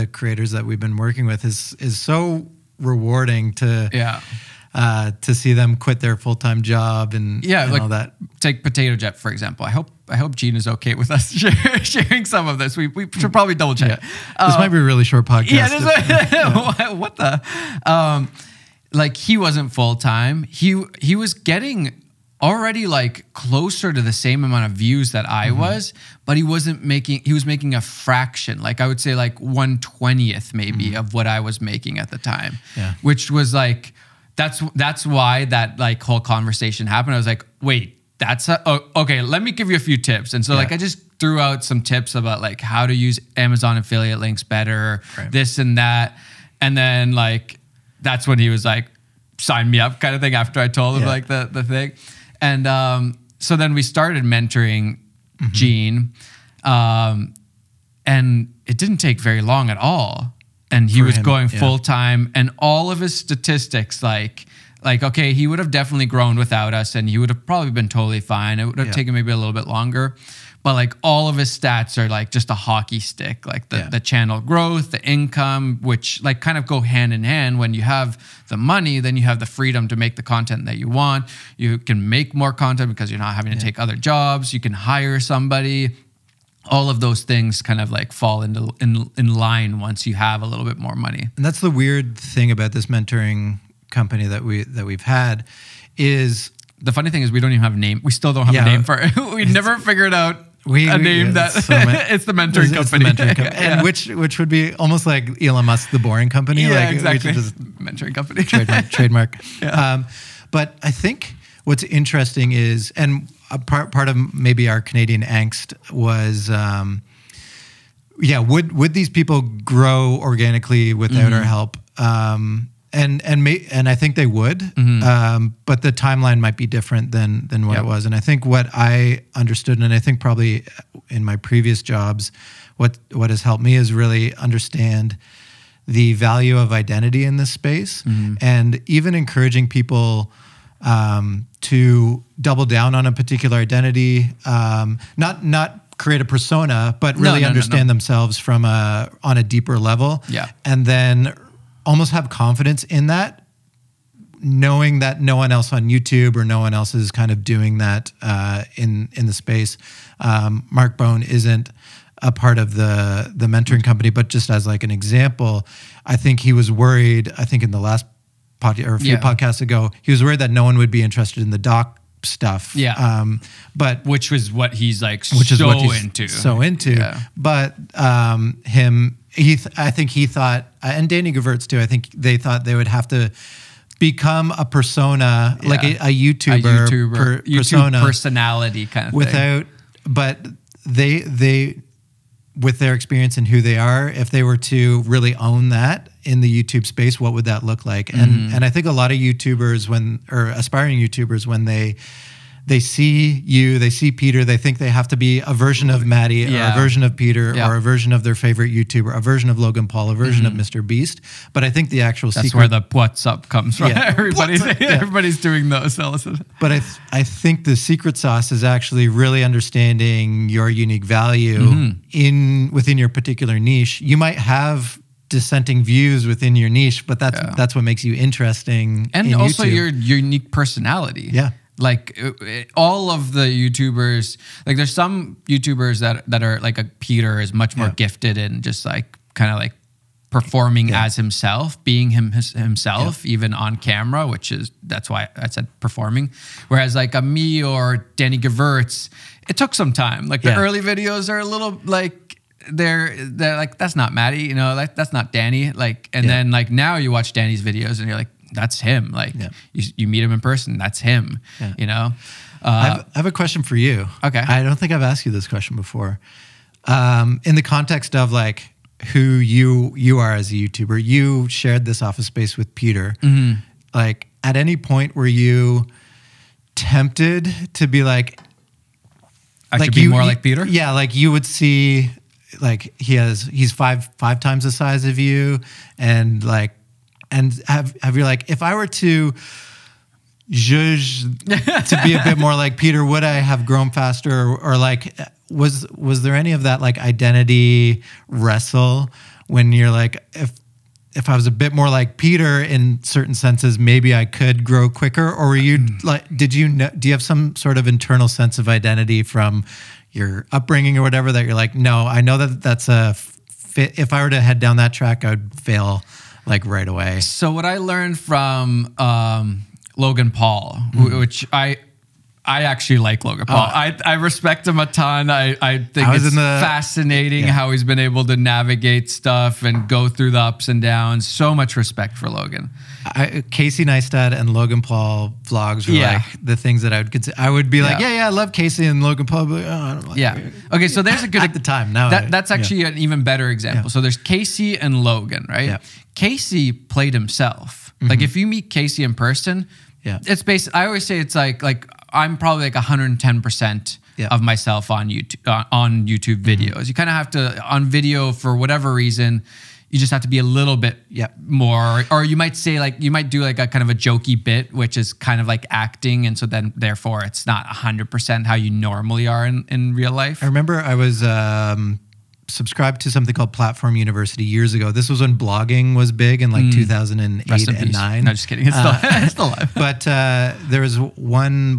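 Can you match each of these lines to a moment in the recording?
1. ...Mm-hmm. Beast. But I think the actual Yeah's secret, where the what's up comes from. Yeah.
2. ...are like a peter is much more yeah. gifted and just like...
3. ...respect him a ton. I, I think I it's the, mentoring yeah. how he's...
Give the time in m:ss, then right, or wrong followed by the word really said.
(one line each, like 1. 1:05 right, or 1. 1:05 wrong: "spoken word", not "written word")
1. 3:30 wrong: "That", not "Yeah"
2. 3:56 right
3. 5:24 wrong: "fascinating", not "mentoring".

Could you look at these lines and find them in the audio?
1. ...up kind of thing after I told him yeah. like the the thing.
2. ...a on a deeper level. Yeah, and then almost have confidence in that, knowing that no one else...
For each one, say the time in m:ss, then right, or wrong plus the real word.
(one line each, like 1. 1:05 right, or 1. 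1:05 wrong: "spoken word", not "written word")
1. 0:49 right
2. 2:28 right.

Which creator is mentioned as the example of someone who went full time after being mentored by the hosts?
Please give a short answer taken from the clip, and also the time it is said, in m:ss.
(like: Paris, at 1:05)
Potato Jet, at 0:08.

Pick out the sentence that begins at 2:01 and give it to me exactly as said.
Um, and and may, and I think they would, mm-hmm.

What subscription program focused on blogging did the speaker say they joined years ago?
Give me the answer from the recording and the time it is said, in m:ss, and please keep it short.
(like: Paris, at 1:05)
Platform University, at 6:13.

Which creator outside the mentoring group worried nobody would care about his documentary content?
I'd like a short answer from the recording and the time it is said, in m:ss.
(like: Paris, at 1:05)
Mark Bone, at 2:40.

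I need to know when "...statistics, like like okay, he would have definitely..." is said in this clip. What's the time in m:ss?
1:03.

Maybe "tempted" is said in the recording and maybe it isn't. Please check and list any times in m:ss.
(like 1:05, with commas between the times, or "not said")
4:36.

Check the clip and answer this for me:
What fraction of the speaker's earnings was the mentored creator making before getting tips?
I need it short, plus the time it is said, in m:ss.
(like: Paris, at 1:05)
1/120th, at 0:29.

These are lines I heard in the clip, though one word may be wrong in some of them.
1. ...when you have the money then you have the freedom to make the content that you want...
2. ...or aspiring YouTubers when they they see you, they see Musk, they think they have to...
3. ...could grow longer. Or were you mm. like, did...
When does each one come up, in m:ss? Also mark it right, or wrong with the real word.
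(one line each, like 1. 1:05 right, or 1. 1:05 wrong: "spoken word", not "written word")
1. 1:17 right
2. 3:20 wrong: "Peter", not "Musk"
3. 5:04 wrong: "quicker", not "longer".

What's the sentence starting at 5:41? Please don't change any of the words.
Now that, that's actually an even better example.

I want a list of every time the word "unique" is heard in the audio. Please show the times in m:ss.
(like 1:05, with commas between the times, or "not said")
3:40, 3:50.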